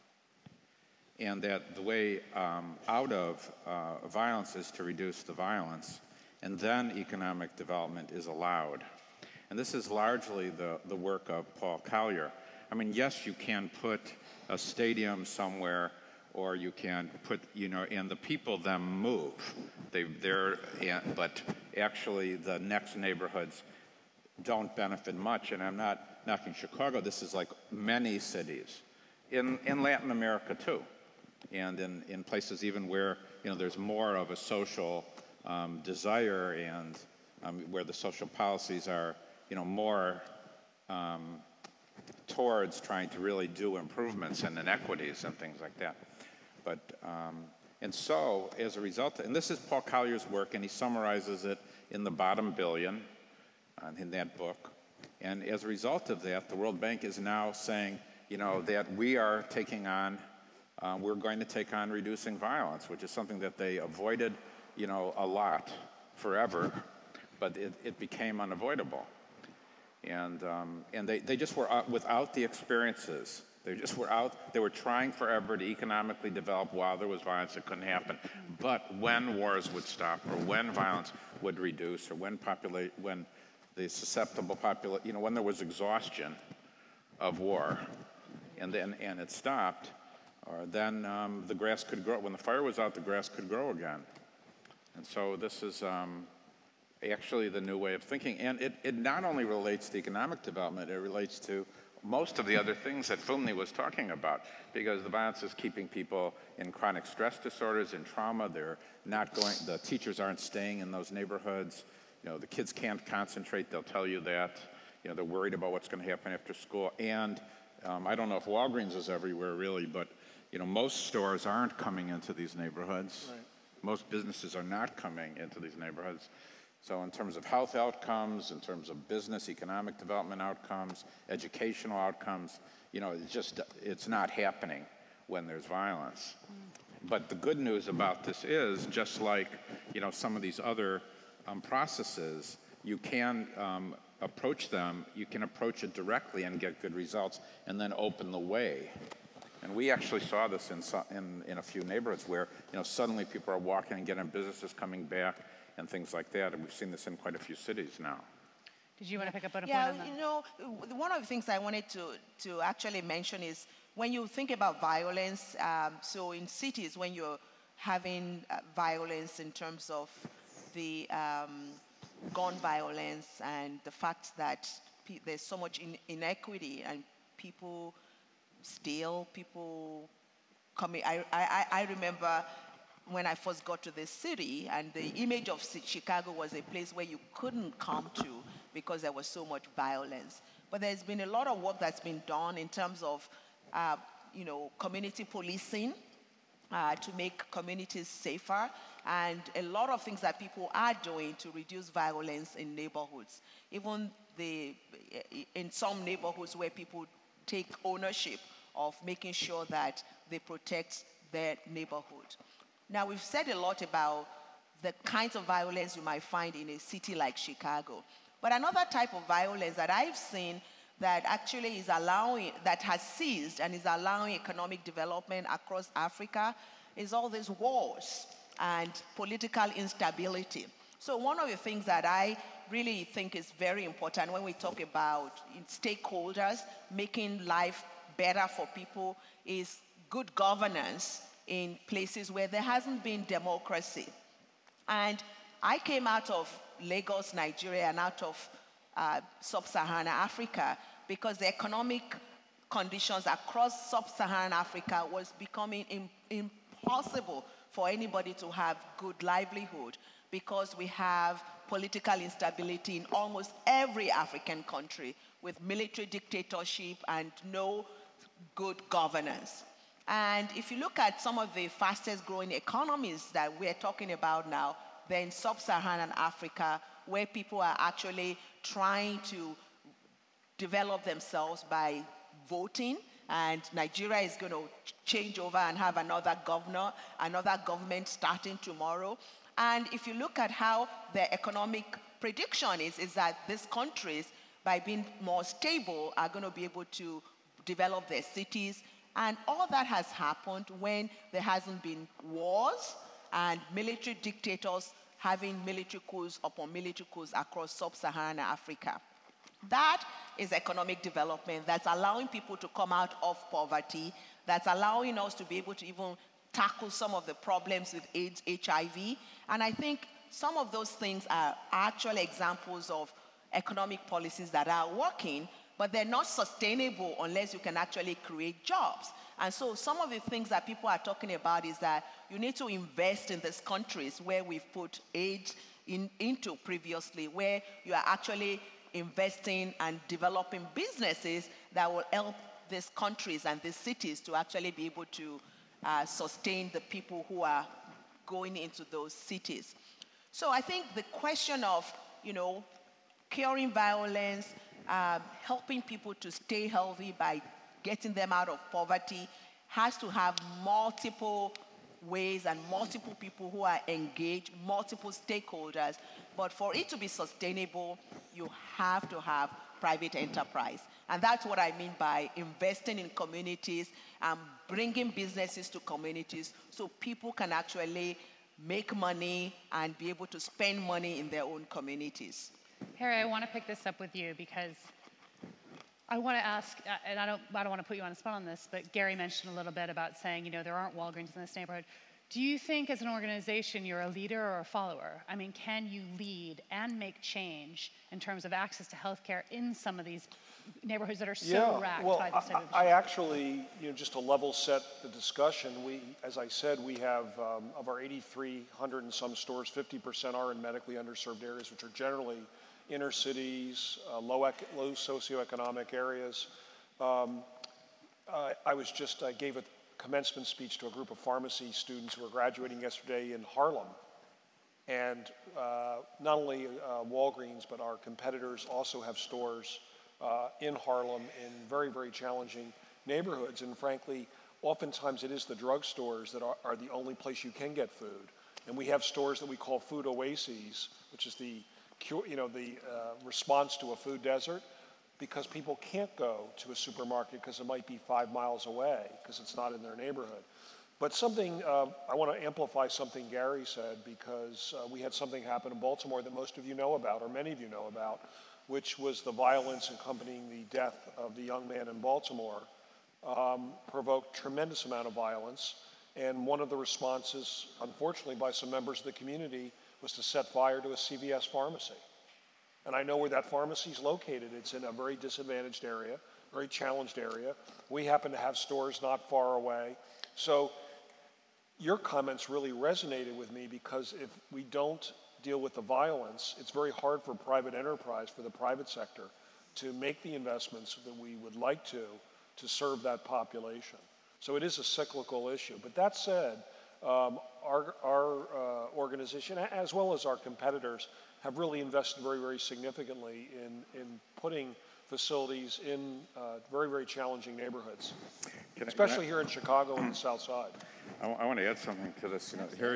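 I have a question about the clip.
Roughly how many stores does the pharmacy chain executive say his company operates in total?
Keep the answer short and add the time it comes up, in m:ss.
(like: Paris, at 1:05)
8,300, at 6:47.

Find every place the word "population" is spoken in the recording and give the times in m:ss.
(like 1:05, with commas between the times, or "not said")
1:24, 8:13.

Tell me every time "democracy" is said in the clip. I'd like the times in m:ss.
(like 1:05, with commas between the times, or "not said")
4:03.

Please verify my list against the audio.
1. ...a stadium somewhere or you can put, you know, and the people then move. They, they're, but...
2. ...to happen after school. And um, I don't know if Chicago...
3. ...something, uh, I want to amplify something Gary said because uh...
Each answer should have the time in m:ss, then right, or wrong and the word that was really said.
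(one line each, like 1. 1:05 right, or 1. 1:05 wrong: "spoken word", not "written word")
1. 0:14 right
2. 1:56 wrong: "Walgreens", not "Chicago"
3. 7:31 right.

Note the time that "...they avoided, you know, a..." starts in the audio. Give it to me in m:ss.
1:03.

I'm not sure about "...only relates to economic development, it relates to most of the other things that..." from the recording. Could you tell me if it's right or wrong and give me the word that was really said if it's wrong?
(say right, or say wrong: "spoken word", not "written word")
right.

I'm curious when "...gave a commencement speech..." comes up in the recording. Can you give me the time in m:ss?
6:59.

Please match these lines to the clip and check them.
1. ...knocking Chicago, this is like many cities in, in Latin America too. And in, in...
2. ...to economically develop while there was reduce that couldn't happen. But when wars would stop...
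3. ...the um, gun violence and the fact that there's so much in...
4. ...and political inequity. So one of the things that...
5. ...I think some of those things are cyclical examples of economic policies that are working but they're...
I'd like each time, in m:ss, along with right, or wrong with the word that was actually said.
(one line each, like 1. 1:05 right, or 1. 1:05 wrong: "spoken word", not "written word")
1. 0:26 right
2. 1:15 wrong: "violence", not "reduce"
3. 2:50 right
4. 3:48 wrong: "instability", not "inequity"
5. 5:19 wrong: "actual", not "cyclical".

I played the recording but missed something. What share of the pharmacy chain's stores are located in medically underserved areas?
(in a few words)
50%.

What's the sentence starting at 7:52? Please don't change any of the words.
And I know where that pharmacy is located.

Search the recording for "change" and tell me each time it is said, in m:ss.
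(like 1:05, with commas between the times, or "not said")
4:45, 6:37.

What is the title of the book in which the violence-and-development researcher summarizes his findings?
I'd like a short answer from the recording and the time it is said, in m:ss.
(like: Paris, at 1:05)
The Bottom Billion, at 0:52.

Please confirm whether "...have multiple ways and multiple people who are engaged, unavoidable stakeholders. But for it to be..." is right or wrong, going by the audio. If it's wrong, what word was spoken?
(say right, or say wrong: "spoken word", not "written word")
wrong: "multiple", not "unavoidable".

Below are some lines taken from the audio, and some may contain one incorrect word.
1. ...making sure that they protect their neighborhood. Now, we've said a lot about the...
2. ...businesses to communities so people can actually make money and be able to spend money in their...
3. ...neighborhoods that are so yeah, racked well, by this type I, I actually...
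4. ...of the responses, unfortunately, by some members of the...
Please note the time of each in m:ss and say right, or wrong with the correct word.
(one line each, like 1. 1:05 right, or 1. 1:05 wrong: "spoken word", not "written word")
1. 3:29 right
2. 6:15 right
3. 6:40 right
4. 7:46 right.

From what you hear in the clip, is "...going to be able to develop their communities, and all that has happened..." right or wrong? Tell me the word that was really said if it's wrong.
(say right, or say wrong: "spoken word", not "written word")
wrong: "cities", not "communities".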